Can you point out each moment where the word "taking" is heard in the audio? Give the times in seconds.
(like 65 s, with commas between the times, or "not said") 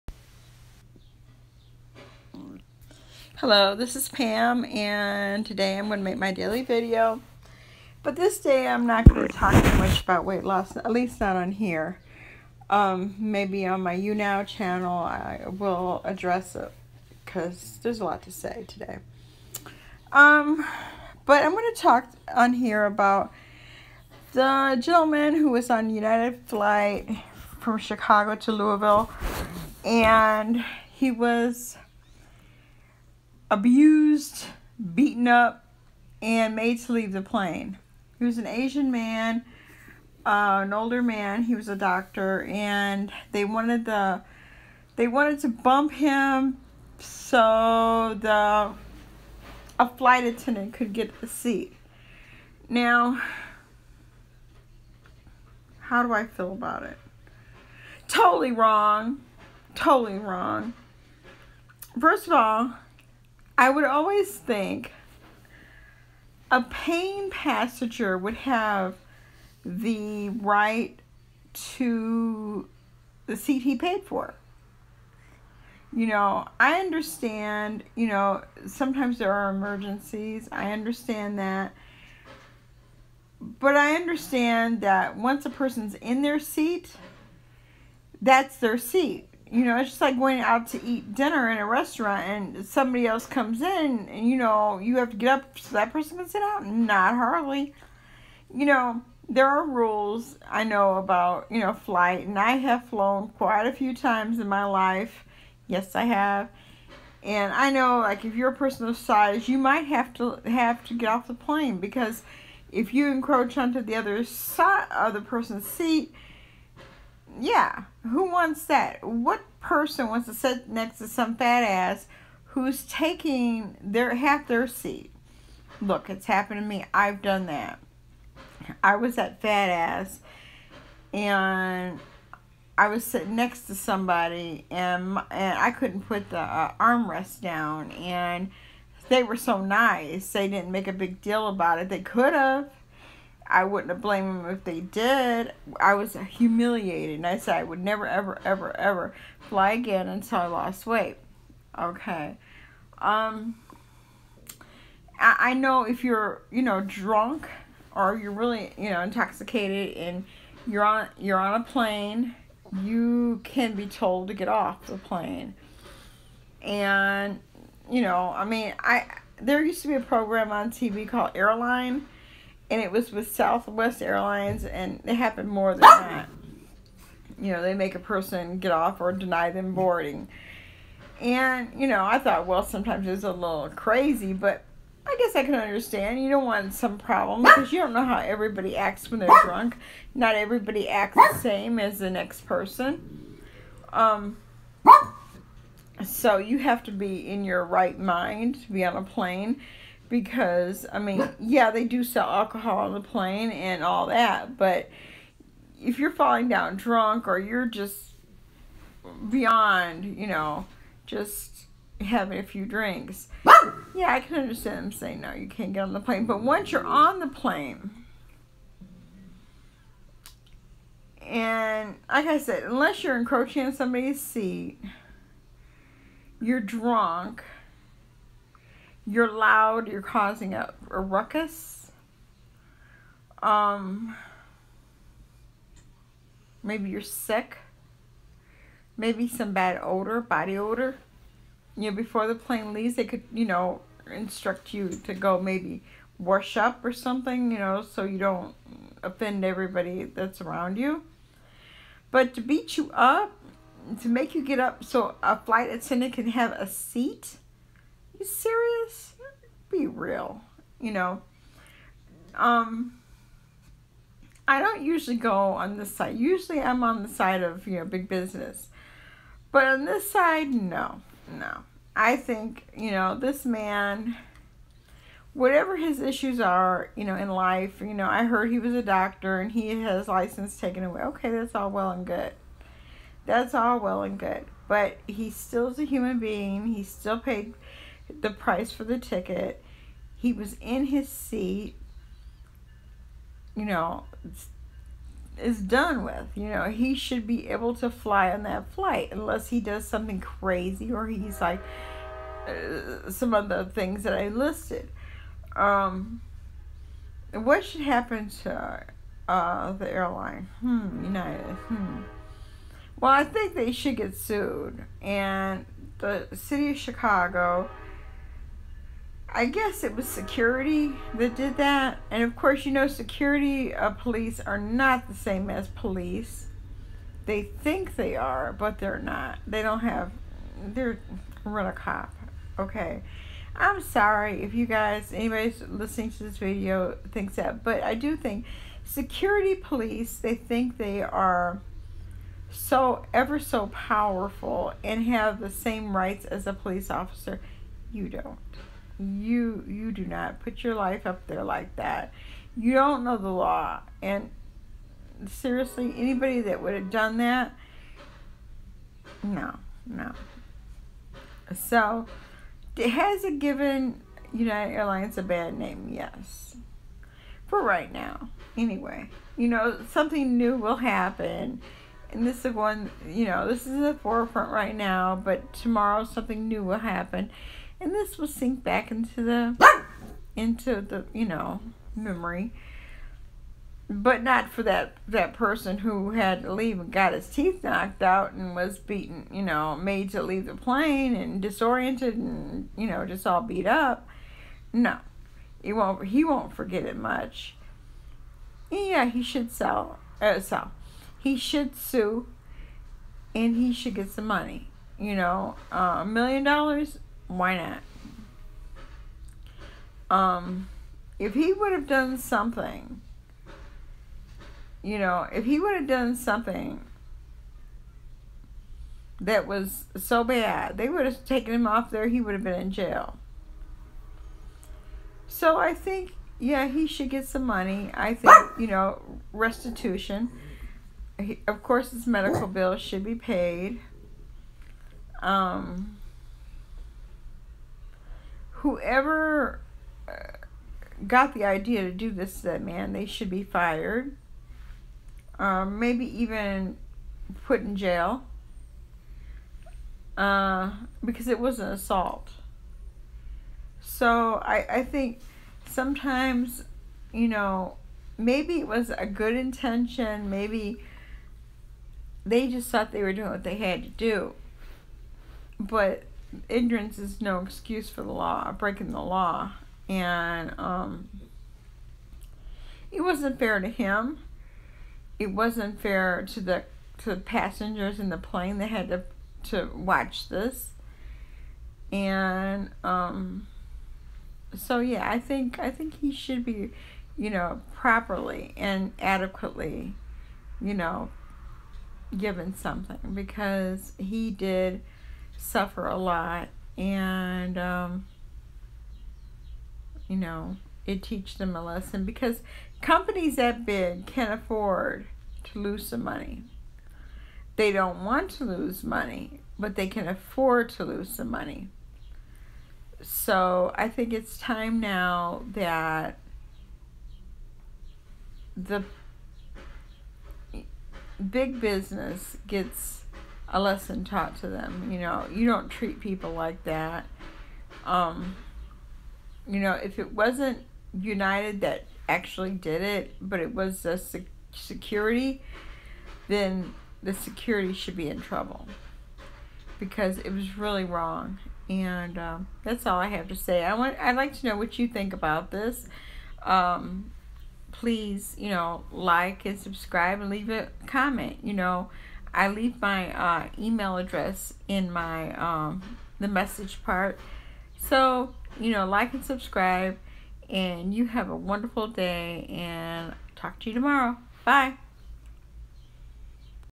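122 s.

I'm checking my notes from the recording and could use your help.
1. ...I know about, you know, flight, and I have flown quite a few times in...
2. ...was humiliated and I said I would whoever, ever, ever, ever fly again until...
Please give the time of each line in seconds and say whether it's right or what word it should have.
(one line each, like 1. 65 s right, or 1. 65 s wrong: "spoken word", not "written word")
1. 100 s right
2. 145 s wrong: "never", not "whoever".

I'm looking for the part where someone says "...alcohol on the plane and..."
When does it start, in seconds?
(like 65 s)
202 s.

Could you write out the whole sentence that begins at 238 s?
Maybe some bad odor, body odor.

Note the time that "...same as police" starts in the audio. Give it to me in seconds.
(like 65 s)
325 s.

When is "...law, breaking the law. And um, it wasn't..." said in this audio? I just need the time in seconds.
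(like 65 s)
468 s.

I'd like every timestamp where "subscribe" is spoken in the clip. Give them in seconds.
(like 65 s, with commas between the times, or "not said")
549 s, 559 s.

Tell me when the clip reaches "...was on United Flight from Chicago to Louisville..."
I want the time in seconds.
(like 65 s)
25 s.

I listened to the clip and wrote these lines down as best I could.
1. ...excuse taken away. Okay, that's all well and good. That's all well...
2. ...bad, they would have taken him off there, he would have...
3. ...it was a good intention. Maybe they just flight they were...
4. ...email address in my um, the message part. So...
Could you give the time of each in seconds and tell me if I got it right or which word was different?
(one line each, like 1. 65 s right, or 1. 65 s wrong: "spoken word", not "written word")
1. 280 s wrong: "license", not "excuse"
2. 420 s right
3. 458 s wrong: "thought", not "flight"
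4. 553 s right.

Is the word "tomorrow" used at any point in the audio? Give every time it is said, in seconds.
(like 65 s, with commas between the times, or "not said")
375 s, 563 s.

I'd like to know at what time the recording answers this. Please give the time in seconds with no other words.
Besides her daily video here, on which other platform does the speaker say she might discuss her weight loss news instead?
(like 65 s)
13 s.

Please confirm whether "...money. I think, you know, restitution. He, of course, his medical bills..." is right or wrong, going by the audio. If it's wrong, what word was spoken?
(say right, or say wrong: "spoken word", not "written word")
right.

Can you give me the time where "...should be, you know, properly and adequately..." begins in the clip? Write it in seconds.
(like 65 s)
486 s.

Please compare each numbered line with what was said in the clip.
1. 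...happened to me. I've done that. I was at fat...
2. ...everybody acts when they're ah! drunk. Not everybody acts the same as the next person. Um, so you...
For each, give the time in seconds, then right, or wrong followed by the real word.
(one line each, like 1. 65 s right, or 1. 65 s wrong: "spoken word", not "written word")
1. 126 s right
2. 188 s right.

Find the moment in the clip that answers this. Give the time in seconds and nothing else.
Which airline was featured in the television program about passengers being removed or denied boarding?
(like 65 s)
173 s.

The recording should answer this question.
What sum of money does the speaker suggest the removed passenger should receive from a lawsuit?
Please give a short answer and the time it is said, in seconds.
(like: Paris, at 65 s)
A million dollars, at 405 s.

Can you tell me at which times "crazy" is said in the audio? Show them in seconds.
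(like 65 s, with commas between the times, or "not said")
183 s, 300 s.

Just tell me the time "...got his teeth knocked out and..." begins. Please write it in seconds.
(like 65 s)
386 s.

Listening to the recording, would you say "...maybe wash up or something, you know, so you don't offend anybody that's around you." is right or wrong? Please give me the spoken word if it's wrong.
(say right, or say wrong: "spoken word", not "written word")
wrong: "everybody", not "anybody".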